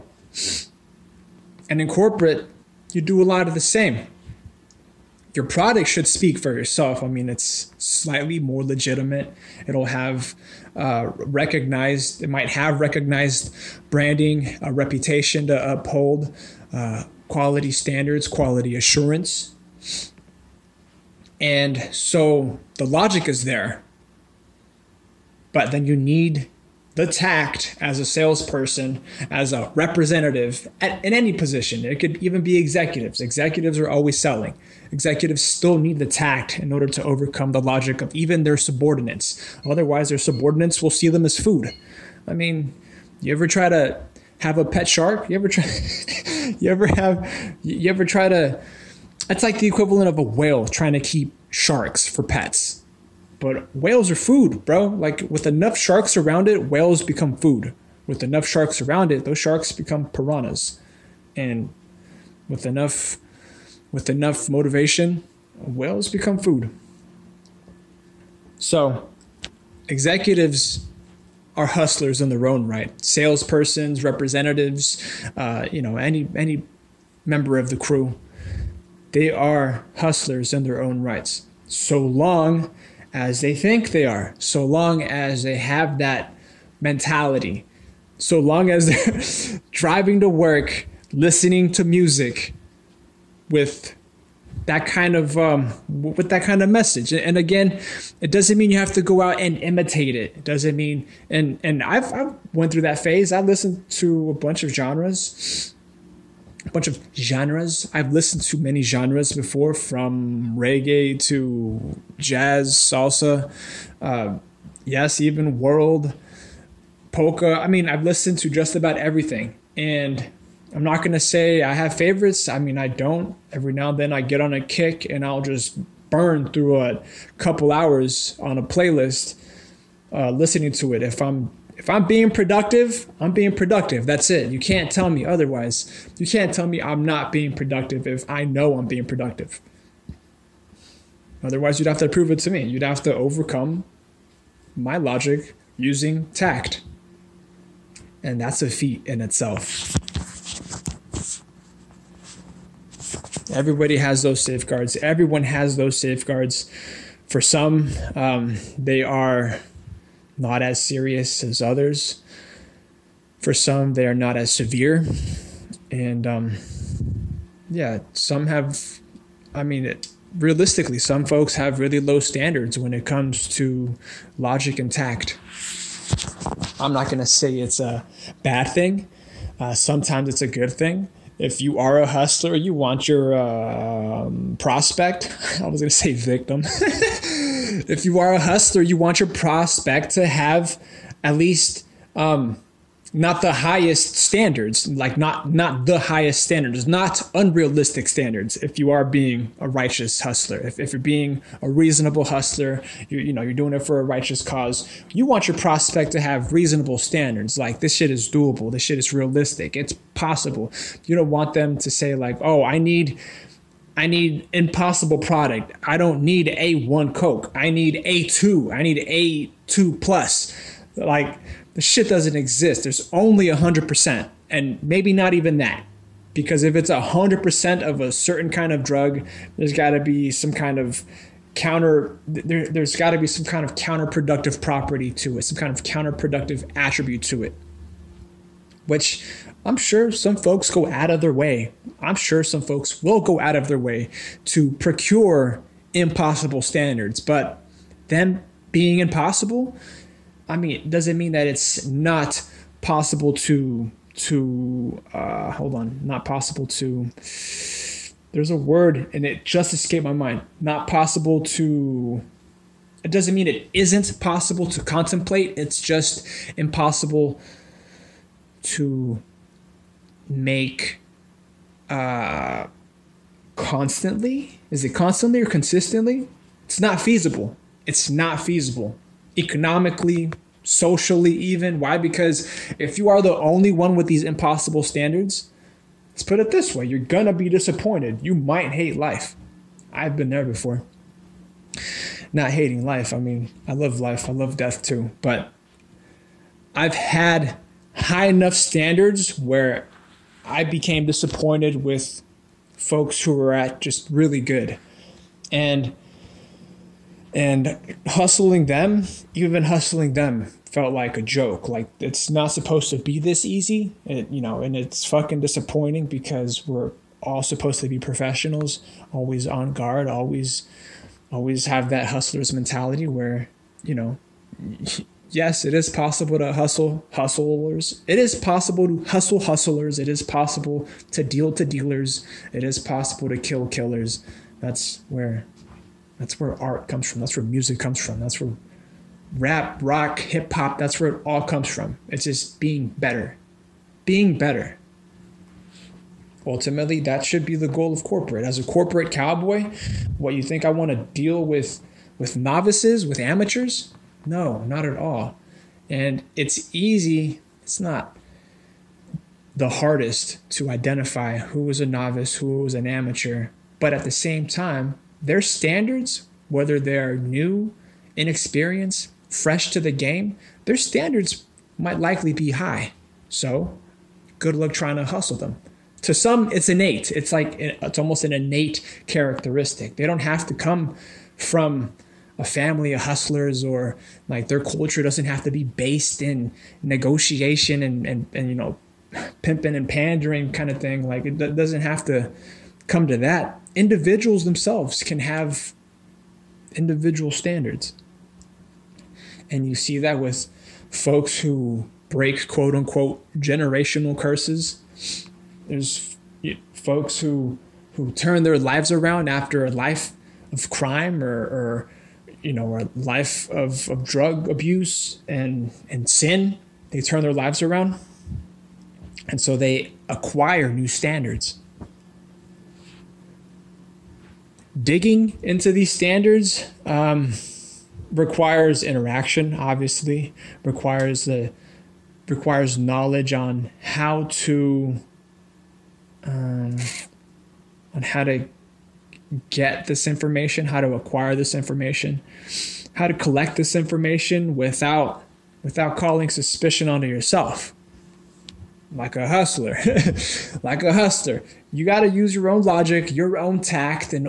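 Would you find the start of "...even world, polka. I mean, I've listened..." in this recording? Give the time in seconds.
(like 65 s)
115 s.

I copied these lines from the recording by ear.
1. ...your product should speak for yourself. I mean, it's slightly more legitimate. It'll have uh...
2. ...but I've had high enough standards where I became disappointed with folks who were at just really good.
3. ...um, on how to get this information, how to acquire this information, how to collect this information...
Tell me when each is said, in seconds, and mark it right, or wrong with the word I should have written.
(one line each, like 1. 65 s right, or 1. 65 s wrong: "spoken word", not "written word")
1. 5 s right
2. 295 s right
3. 436 s right.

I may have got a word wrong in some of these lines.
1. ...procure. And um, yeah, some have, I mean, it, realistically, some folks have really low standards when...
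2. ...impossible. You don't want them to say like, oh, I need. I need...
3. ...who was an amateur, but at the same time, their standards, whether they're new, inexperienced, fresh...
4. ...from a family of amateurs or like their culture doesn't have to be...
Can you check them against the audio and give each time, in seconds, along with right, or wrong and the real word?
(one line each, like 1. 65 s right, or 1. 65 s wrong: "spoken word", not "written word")
1. 164 s wrong: "severe", not "procure"
2. 210 s wrong: "possible", not "impossible"
3. 362 s right
4. 381 s wrong: "hustlers", not "amateurs".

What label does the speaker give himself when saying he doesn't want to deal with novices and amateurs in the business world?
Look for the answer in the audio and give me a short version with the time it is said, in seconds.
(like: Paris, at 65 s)
corporate cowboy, at 348 s.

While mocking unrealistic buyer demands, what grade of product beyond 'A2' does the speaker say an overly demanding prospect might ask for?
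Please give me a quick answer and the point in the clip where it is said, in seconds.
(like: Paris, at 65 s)
A2 plus, at 219 s.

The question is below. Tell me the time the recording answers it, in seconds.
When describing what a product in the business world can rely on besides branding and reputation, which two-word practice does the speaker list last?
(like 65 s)
18 s.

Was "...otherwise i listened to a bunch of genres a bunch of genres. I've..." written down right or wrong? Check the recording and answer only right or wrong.
wrong.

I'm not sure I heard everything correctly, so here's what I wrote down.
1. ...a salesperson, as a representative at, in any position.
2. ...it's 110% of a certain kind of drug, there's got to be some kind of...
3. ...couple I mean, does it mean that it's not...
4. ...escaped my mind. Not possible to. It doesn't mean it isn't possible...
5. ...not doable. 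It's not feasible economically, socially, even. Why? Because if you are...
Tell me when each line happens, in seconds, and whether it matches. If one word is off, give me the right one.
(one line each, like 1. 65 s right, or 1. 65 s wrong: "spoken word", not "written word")
1. 27 s right
2. 226 s wrong: "100", not "110"
3. 248 s wrong: "impossible", not "couple"
4. 259 s right
5. 276 s wrong: "feasible", not "doable".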